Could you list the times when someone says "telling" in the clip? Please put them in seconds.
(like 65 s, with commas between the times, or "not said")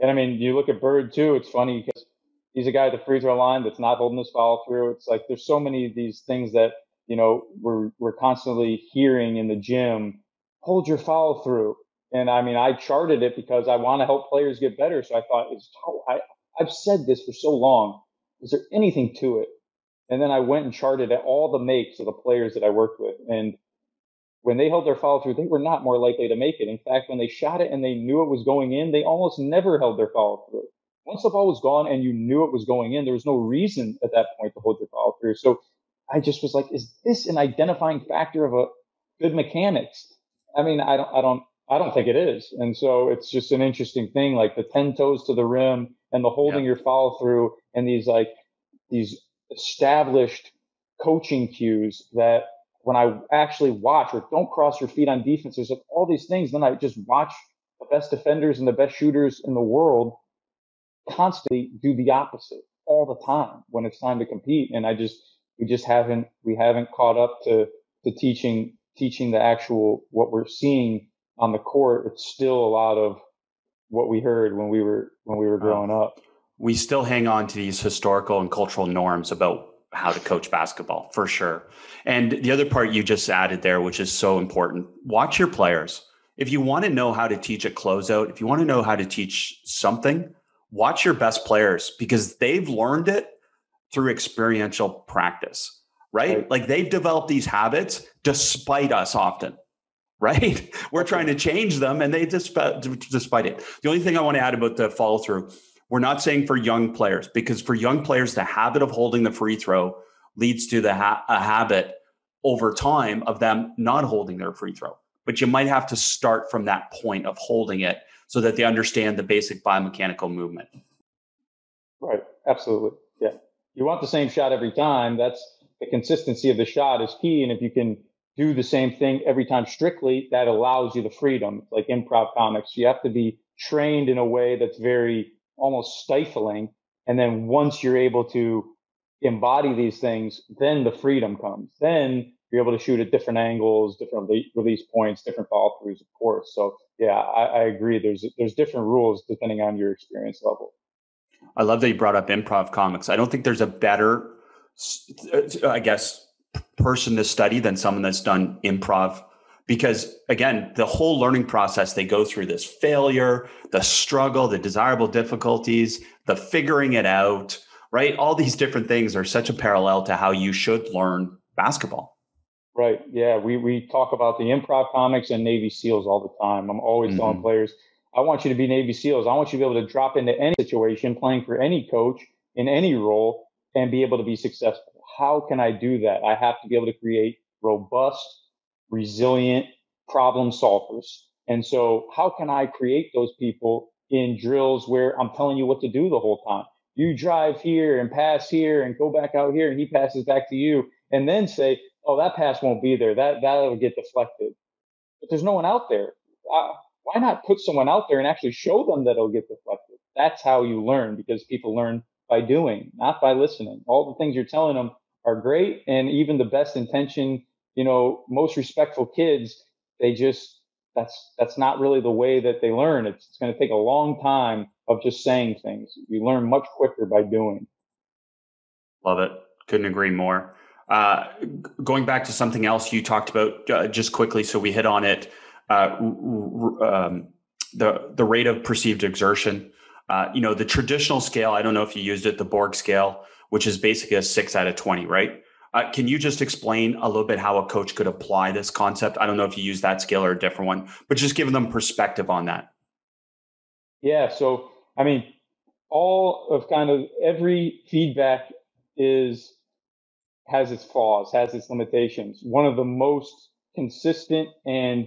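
177 s, 195 s, 214 s.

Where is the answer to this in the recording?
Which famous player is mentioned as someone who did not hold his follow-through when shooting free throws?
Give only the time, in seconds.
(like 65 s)
0 s.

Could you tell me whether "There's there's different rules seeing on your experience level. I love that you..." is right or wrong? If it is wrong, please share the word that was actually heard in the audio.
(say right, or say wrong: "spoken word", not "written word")
wrong: "depending", not "seeing".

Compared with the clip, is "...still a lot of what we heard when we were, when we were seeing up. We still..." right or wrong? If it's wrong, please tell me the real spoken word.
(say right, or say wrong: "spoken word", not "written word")
wrong: "growing", not "seeing".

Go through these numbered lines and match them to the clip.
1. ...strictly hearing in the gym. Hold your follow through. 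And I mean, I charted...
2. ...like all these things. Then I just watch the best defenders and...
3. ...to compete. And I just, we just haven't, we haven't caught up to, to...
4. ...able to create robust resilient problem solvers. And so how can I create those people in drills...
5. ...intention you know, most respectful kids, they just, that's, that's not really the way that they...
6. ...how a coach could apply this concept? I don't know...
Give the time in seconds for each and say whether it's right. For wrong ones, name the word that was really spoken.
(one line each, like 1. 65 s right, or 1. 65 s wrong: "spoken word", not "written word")
1. 8 s wrong: "constantly", not "strictly"
2. 55 s right
3. 64 s right
4. 186 s right
5. 216 s right
6. 247 s right.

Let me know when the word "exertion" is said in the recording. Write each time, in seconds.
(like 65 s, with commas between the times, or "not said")
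239 s.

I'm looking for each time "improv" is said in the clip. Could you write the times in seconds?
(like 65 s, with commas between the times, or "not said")
131 s, 152 s, 158 s, 174 s.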